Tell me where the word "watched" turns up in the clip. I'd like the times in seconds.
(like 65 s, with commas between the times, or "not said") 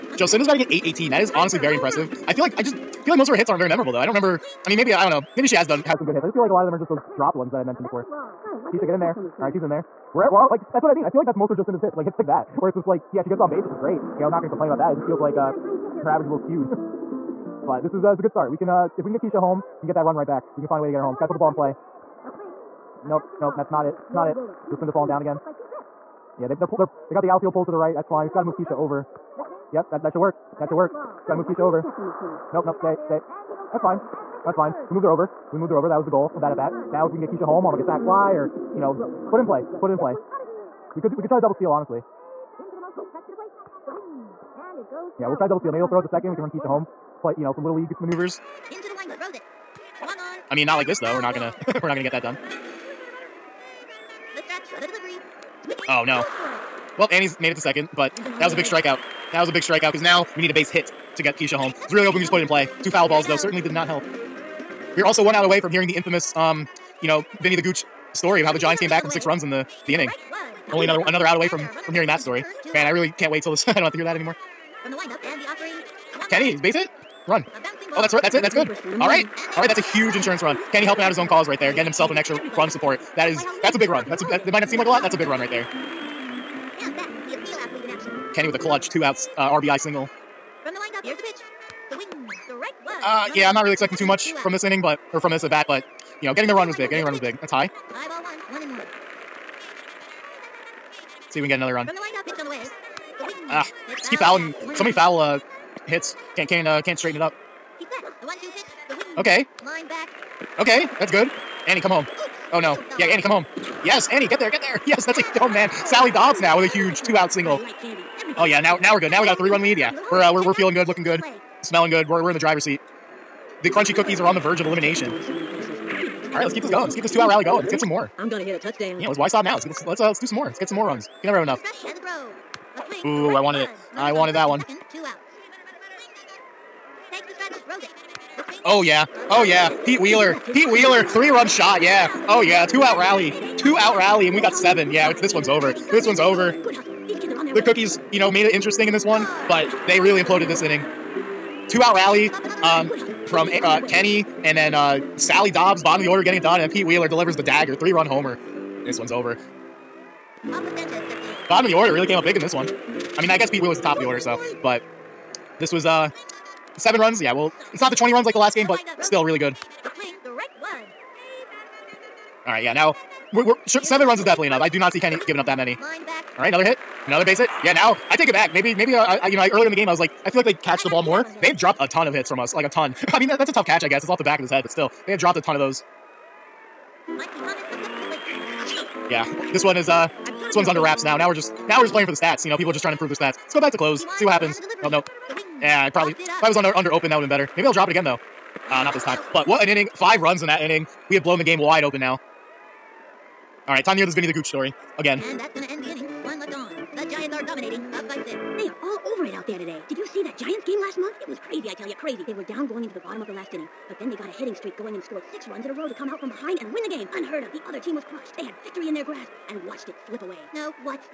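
219 s.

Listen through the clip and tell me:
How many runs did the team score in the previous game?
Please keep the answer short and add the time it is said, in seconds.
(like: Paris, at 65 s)
20, at 167 s.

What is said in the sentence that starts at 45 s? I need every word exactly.
Maybe they'll throw it to second.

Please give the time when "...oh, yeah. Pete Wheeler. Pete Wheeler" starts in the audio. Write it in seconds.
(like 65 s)
139 s.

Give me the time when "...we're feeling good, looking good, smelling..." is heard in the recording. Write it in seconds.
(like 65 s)
120 s.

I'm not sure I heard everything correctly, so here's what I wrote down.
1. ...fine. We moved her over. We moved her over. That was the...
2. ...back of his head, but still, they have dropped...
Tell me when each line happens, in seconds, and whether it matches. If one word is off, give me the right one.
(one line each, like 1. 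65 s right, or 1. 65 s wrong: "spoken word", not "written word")
1. 34 s right
2. 184 s right.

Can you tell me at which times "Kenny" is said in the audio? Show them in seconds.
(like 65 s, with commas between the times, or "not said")
76 s, 80 s, 88 s, 153 s, 174 s.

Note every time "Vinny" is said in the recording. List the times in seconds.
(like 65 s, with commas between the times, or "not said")
67 s, 204 s.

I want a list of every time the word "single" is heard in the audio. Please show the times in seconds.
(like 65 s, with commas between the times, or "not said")
89 s, 117 s.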